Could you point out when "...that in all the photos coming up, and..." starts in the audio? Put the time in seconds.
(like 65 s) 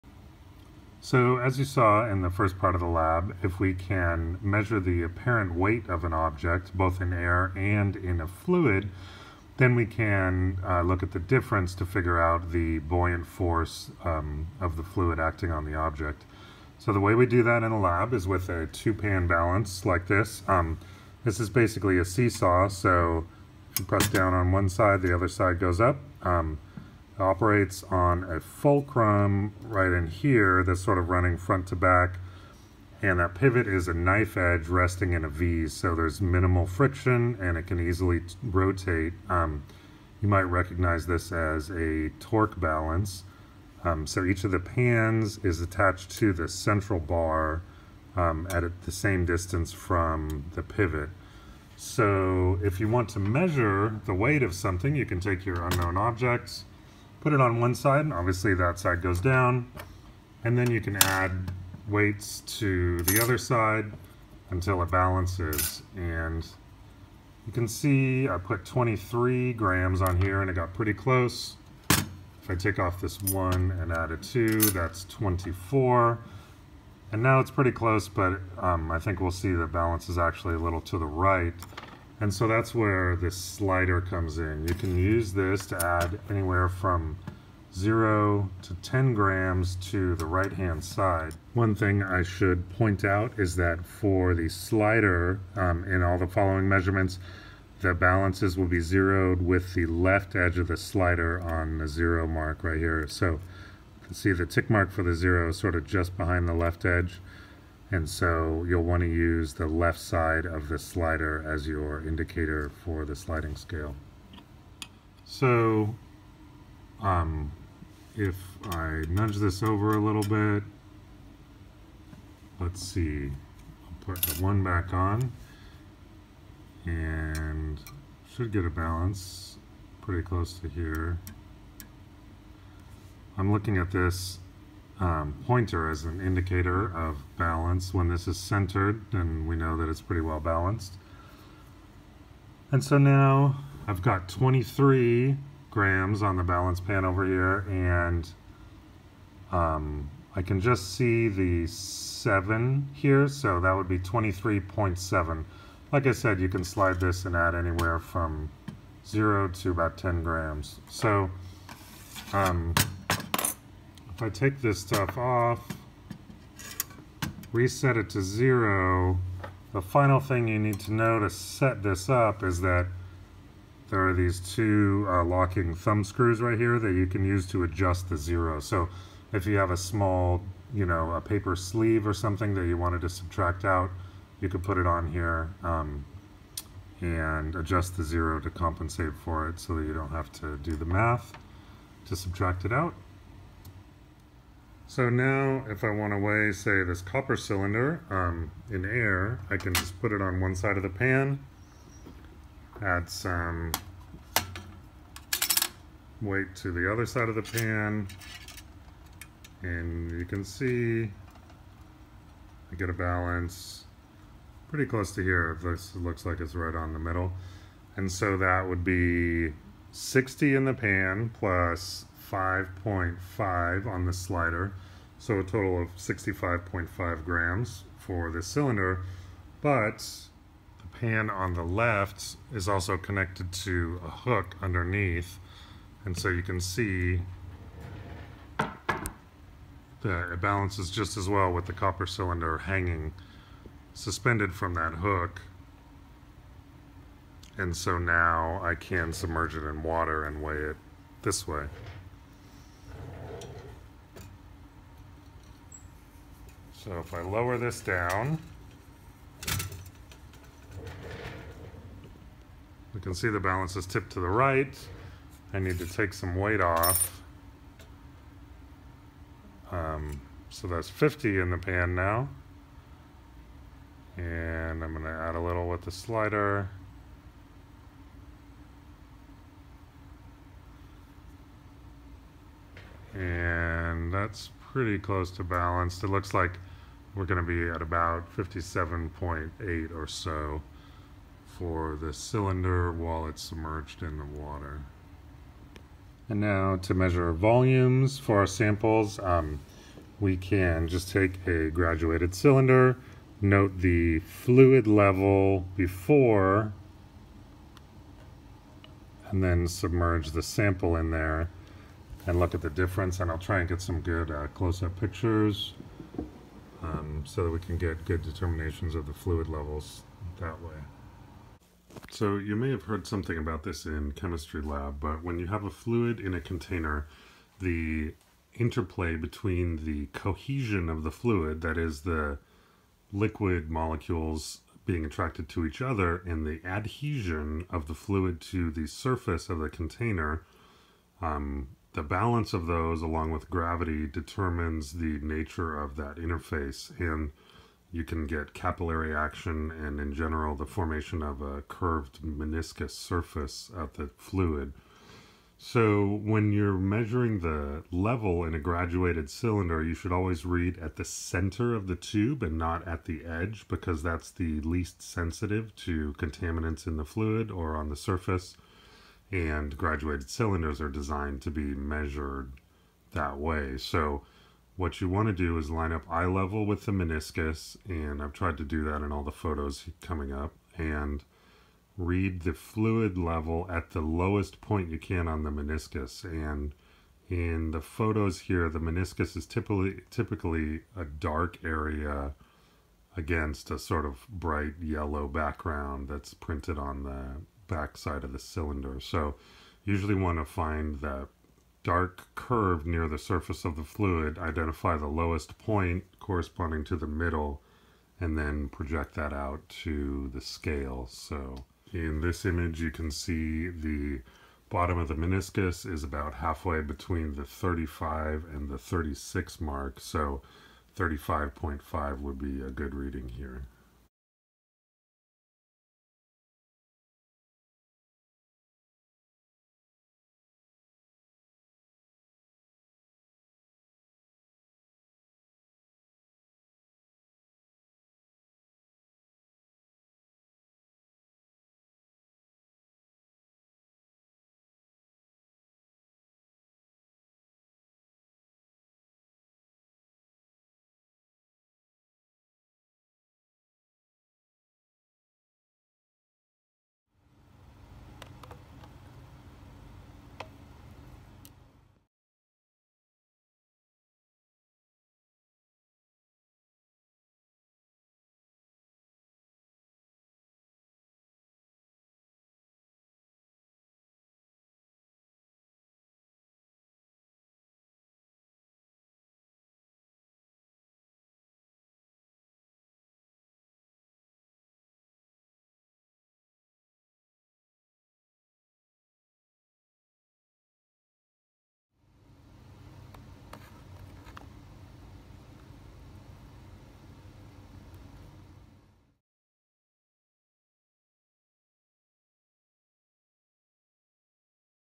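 378 s.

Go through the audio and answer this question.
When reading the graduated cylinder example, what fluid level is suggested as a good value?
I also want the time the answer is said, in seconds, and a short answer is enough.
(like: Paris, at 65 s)
35.5, at 420 s.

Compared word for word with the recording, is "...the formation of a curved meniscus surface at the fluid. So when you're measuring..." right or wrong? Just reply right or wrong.
right.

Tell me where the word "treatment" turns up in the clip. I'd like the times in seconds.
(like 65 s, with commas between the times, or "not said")
not said.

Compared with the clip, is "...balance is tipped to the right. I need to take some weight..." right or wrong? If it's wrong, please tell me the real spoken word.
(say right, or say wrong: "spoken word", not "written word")
right.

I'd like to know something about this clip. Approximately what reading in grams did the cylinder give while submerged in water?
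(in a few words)
57.8.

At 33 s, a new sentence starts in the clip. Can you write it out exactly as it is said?
And that pivot is a knife edge resting in a V, so there's minimal friction and it can easily rotate.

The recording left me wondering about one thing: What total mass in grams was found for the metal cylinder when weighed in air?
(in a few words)
65.5 grams.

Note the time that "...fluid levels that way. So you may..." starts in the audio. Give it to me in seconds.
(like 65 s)
319 s.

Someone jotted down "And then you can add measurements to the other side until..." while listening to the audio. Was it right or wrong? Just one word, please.
wrong.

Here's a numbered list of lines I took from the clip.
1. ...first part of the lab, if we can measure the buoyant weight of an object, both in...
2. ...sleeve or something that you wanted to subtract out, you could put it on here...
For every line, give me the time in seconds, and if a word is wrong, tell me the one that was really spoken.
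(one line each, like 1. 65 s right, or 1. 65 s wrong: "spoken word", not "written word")
1. 2 s wrong: "apparent", not "buoyant"
2. 181 s right.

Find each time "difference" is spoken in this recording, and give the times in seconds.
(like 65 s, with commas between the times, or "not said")
11 s, 312 s.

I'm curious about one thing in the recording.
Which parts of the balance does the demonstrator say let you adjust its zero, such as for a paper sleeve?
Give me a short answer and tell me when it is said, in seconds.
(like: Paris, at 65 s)
locking thumb screws, at 175 s.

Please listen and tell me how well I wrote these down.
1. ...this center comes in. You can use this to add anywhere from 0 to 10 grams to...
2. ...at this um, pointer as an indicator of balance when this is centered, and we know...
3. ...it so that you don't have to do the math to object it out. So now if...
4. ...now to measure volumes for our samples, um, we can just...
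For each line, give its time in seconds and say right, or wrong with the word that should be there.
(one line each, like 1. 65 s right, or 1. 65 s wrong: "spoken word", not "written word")
1. 83 s wrong: "slider", not "center"
2. 133 s right
3. 189 s wrong: "subtract", not "object"
4. 296 s right.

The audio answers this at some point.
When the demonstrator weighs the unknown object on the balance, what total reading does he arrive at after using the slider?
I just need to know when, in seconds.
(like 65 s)
153 s.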